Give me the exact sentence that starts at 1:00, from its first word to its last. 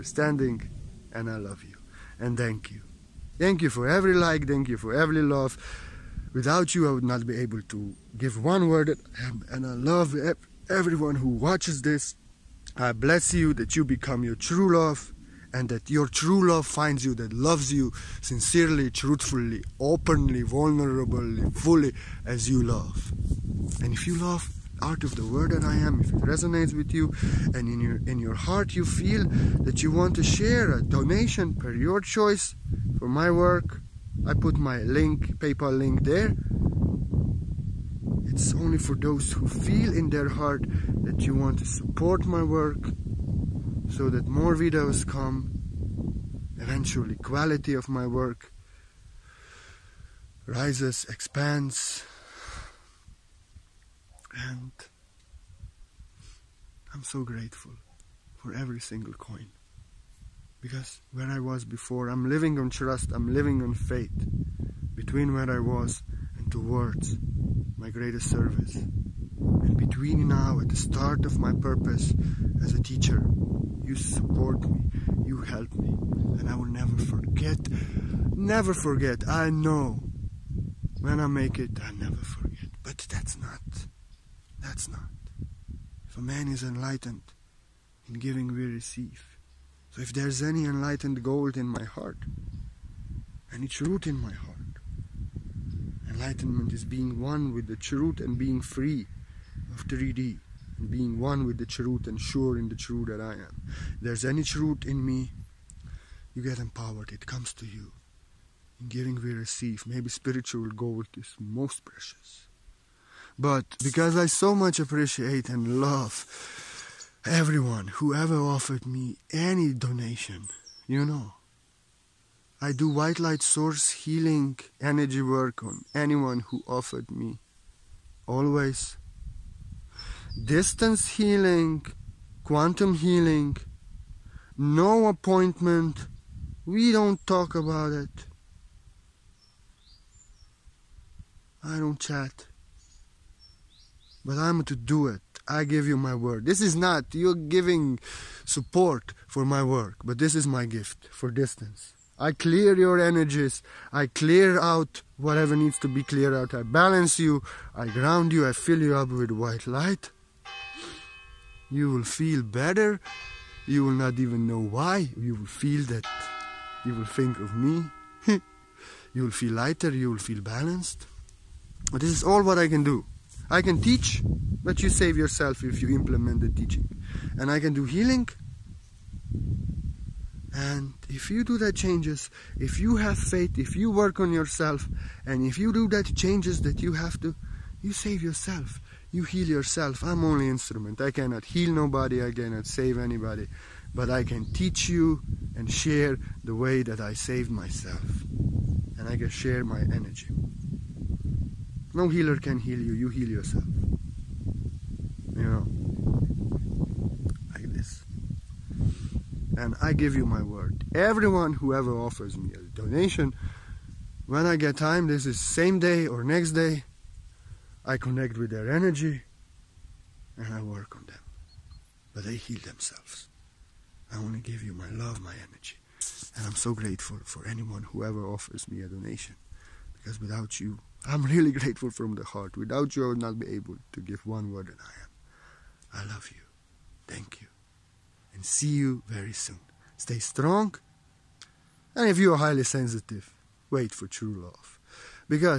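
Because where I was before, I'm living on trust, I'm living on faith.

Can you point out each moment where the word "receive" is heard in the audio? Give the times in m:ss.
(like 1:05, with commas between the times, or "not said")
1:28, 1:49.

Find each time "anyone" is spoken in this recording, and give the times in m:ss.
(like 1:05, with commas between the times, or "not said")
2:05, 3:47.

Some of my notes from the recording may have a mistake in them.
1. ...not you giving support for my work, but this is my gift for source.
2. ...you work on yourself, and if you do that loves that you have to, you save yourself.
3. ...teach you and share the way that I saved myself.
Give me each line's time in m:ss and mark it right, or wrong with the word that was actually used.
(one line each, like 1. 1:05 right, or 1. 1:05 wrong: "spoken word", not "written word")
1. 2:26 wrong: "distance", not "source"
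2. 3:03 wrong: "changes", not "loves"
3. 3:14 right.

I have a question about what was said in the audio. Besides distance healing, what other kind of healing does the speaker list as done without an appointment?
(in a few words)
Quantum healing.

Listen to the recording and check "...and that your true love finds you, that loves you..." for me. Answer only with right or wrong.
right.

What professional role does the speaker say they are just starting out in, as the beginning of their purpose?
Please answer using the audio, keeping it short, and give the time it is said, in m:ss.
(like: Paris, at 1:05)
Teacher, at 1:12.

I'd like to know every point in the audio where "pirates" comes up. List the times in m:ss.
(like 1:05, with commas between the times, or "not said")
not said.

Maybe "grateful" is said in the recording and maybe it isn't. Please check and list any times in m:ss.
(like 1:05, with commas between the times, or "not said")
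0:57, 3:46, 3:51.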